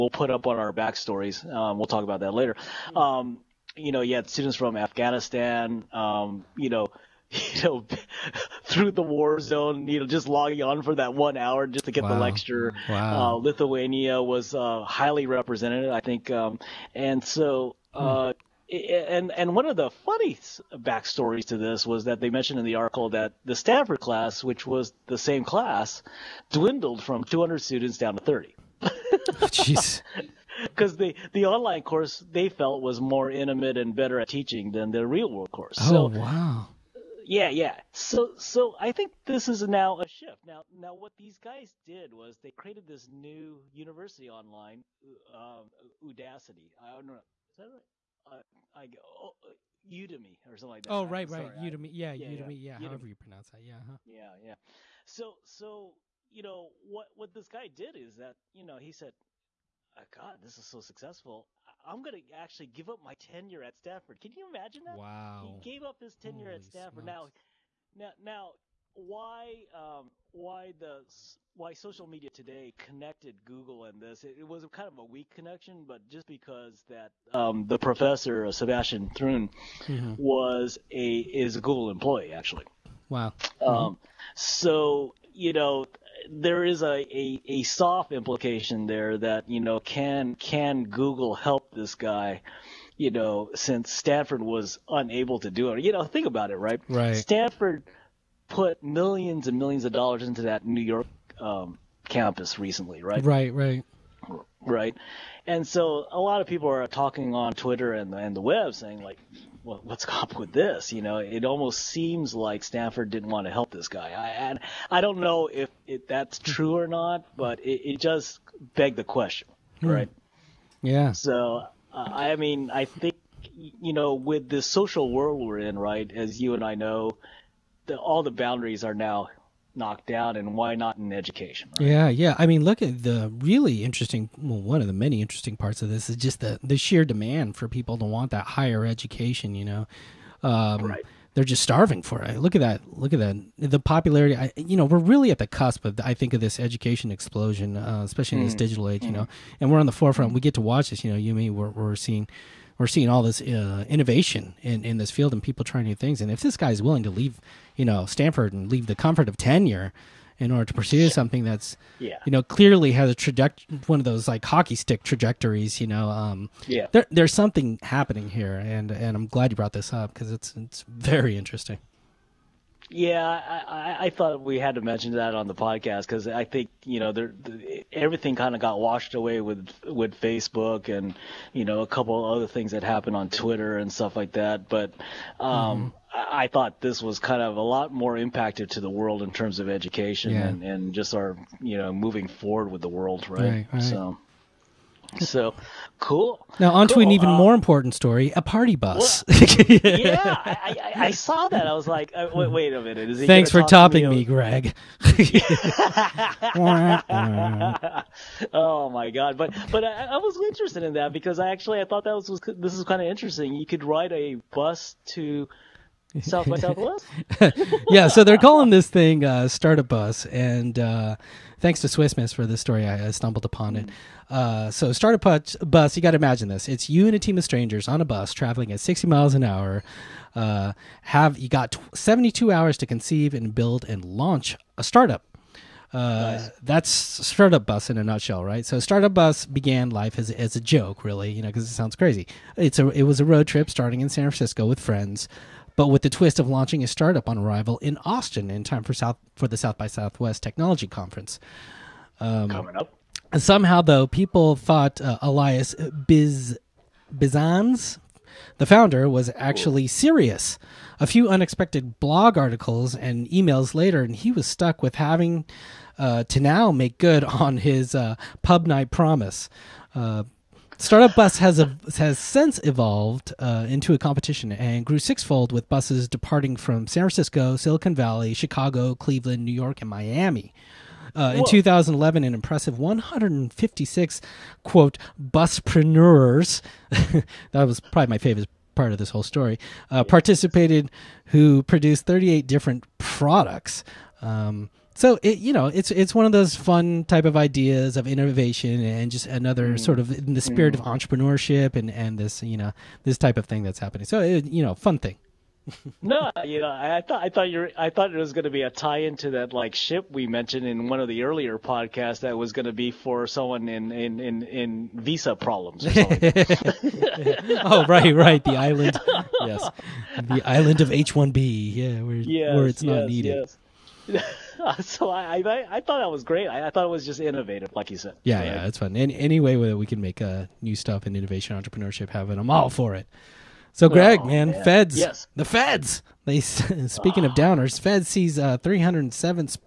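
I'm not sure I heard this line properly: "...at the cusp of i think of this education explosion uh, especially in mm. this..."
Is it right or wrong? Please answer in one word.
right.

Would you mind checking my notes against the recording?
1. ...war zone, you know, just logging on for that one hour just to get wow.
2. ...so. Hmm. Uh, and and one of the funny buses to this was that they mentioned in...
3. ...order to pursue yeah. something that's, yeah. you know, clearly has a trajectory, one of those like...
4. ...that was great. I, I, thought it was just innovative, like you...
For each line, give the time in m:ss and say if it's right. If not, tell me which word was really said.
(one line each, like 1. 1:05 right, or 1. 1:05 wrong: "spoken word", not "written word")
1. 0:09 right
2. 0:17 wrong: "backstories", not "buses"
3. 2:40 right
4. 5:25 right.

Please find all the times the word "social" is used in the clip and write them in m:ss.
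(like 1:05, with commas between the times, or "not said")
1:11, 2:04.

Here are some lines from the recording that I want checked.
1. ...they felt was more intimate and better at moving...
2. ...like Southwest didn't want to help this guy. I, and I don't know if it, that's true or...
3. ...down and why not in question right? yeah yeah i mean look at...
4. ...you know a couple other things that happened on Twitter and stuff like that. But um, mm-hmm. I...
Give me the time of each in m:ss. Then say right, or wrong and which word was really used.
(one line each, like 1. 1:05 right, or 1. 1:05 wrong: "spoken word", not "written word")
1. 0:32 wrong: "teaching", not "moving"
2. 1:52 wrong: "Stanford", not "Southwest"
3. 2:10 wrong: "education", not "question"
4. 3:01 right.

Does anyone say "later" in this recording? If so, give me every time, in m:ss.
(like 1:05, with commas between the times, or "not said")
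0:02, 4:23.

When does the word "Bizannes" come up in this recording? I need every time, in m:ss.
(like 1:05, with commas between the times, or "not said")
4:17.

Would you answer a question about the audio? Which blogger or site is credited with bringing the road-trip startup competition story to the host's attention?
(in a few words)
Swissmiss.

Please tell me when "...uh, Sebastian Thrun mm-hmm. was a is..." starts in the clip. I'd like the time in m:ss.
1:18.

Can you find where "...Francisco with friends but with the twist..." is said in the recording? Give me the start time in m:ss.
4:04.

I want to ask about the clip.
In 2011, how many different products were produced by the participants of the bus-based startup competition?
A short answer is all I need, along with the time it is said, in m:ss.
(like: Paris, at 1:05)
38, at 4:52.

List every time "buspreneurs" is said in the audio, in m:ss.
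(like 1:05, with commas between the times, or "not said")
4:45.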